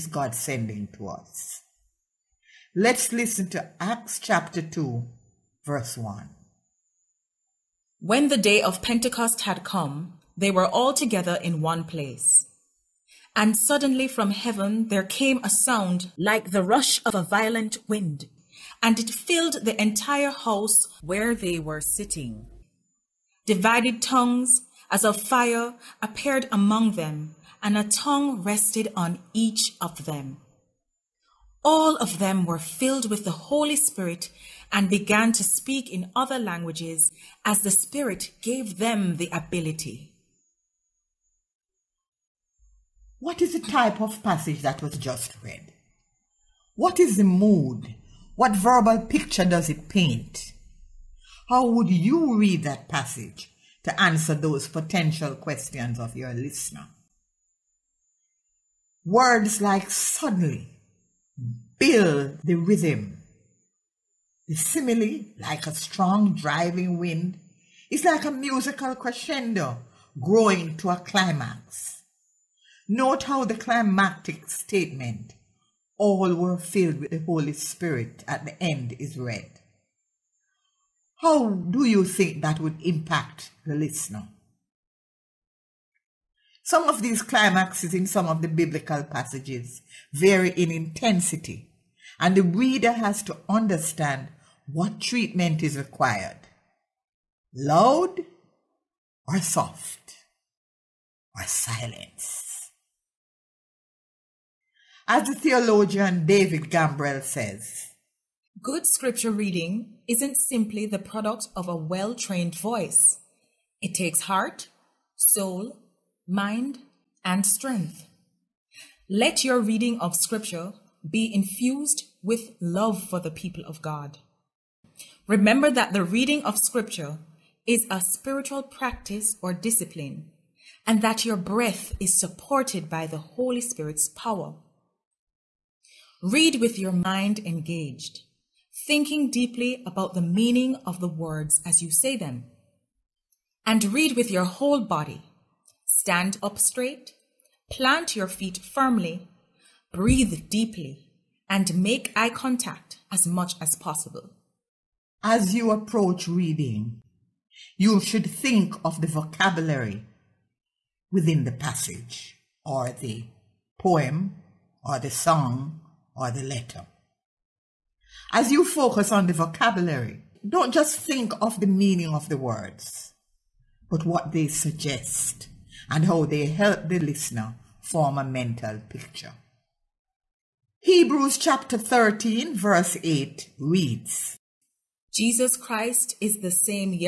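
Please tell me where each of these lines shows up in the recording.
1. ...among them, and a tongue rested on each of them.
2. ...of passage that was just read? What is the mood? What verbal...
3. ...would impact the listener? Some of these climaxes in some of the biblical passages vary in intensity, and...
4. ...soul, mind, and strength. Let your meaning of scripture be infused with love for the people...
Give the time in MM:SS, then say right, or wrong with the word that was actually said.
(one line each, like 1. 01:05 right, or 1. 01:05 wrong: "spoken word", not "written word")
1. 00:26 right
2. 00:44 right
3. 01:22 right
4. 01:55 wrong: "reading", not "meaning".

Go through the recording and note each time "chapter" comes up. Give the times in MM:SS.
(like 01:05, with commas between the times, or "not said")
00:04, 03:01.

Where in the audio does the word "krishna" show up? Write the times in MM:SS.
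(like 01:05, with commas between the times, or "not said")
not said.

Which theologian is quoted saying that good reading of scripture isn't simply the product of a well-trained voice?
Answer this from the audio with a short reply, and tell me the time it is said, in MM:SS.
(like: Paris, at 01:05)
David Gambrell, at 01:46.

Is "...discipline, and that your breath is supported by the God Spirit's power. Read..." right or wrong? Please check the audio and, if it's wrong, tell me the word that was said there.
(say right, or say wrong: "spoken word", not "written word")
wrong: "Holy", not "God".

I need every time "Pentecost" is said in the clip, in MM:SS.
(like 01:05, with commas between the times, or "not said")
00:08.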